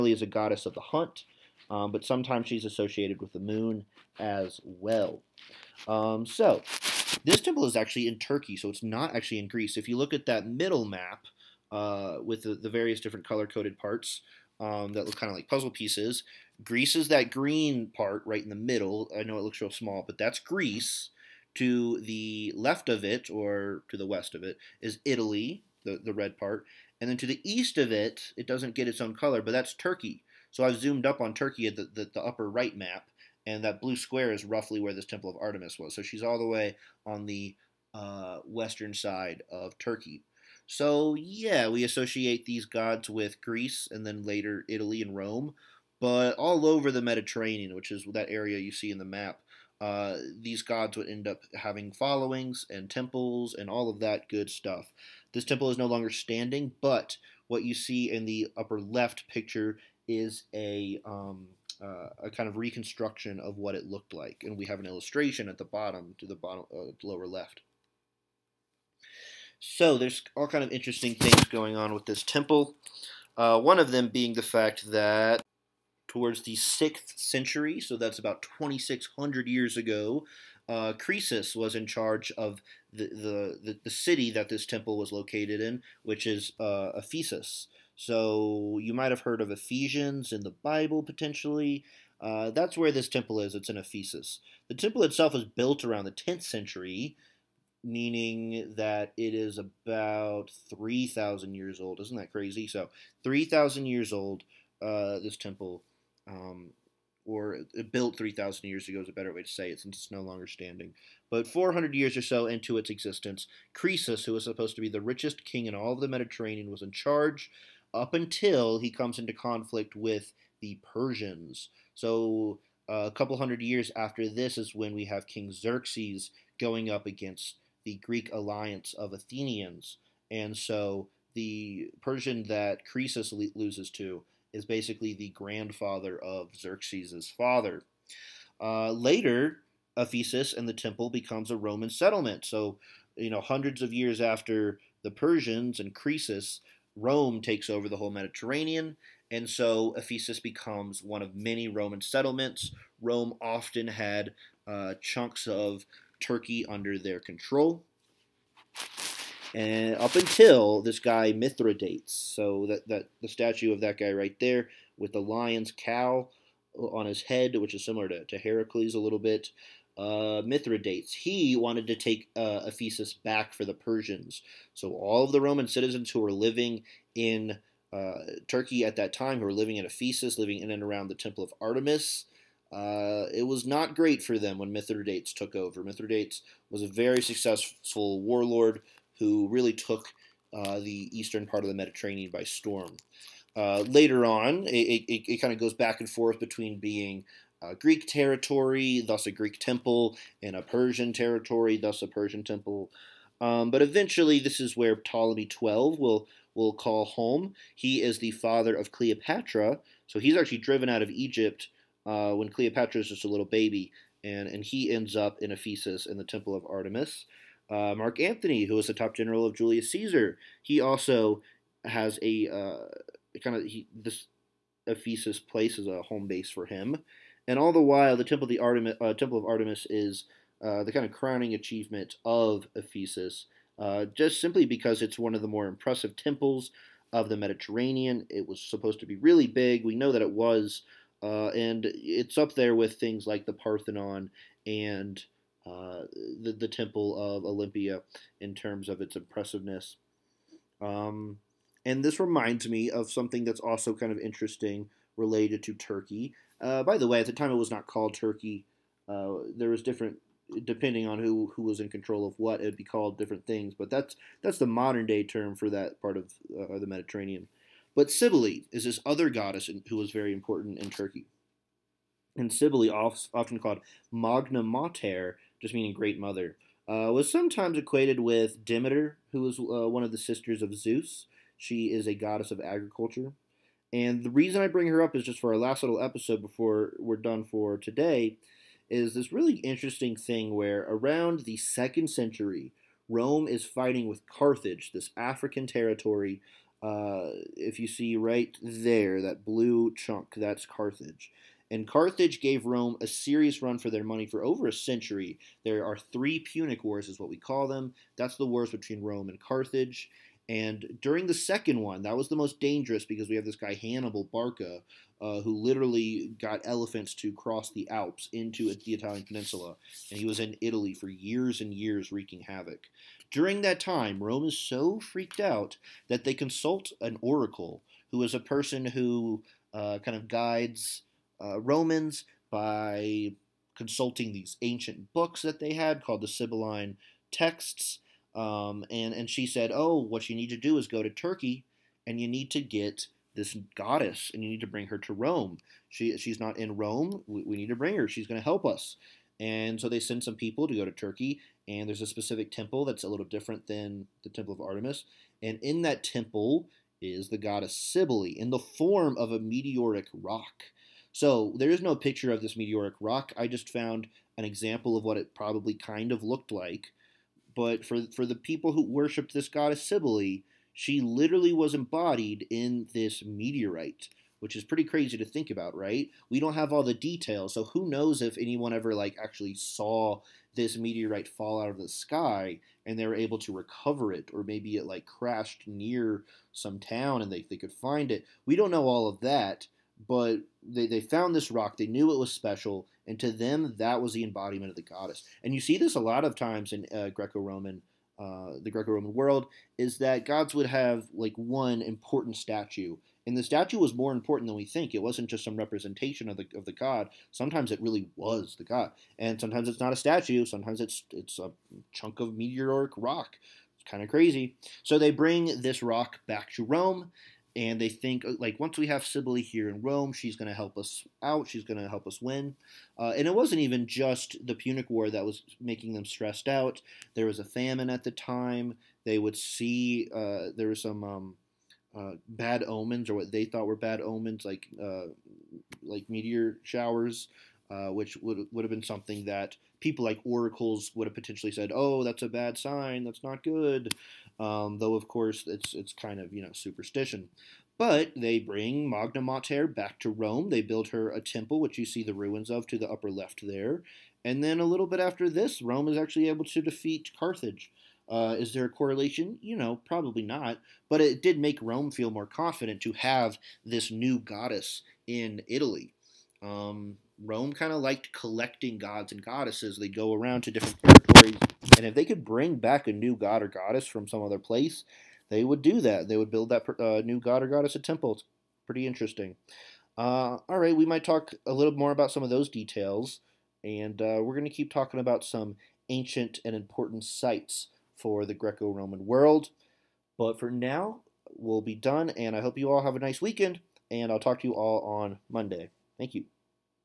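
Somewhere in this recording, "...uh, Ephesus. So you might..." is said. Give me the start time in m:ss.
1:26.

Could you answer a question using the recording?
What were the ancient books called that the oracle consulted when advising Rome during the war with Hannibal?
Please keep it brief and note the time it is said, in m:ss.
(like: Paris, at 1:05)
Sibylline Texts, at 5:36.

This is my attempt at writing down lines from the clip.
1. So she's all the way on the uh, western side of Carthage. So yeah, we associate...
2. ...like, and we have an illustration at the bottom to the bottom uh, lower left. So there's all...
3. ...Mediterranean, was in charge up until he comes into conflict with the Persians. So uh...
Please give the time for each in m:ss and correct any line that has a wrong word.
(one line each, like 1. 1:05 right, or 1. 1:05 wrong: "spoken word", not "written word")
1. 0:35 wrong: "Turkey", not "Carthage"
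2. 1:04 right
3. 1:56 right.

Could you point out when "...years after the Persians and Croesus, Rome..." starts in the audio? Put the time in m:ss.
2:23.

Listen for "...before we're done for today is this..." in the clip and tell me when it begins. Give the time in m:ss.
4:46.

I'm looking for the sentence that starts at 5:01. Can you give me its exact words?
And Carthage gave Rome a serious run for their money for over a century.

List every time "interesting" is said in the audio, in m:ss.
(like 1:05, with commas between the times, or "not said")
1:10, 4:14, 4:49, 7:58.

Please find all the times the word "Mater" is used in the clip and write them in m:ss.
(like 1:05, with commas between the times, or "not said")
4:34, 7:29.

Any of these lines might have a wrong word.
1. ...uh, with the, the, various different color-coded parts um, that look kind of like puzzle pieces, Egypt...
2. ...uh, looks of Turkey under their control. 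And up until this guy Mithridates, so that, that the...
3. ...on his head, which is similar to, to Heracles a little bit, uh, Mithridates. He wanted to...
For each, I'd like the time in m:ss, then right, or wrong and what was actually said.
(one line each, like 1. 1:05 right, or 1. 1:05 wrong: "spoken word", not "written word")
1. 0:11 wrong: "Greece", not "Egypt"
2. 2:34 wrong: "chunks", not "looks"
3. 2:46 right.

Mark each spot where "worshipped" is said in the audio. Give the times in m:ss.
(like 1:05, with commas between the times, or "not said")
6:08.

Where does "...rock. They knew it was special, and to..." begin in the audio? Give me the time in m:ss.
6:31.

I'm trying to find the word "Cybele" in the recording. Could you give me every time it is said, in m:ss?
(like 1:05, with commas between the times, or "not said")
4:28, 4:32, 5:57, 6:09, 6:59.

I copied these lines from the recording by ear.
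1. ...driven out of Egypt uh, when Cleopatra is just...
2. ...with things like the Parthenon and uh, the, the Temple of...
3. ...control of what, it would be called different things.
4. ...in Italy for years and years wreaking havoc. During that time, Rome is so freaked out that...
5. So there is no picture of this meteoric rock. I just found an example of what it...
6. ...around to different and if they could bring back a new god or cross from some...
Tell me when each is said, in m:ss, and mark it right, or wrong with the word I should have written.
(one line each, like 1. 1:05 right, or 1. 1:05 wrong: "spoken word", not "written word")
1. 3:30 right
2. 4:02 right
3. 4:21 right
4. 5:20 right
5. 6:01 right
6. 7:50 wrong: "goddess", not "cross".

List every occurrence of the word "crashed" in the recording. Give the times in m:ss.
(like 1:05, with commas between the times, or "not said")
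6:25.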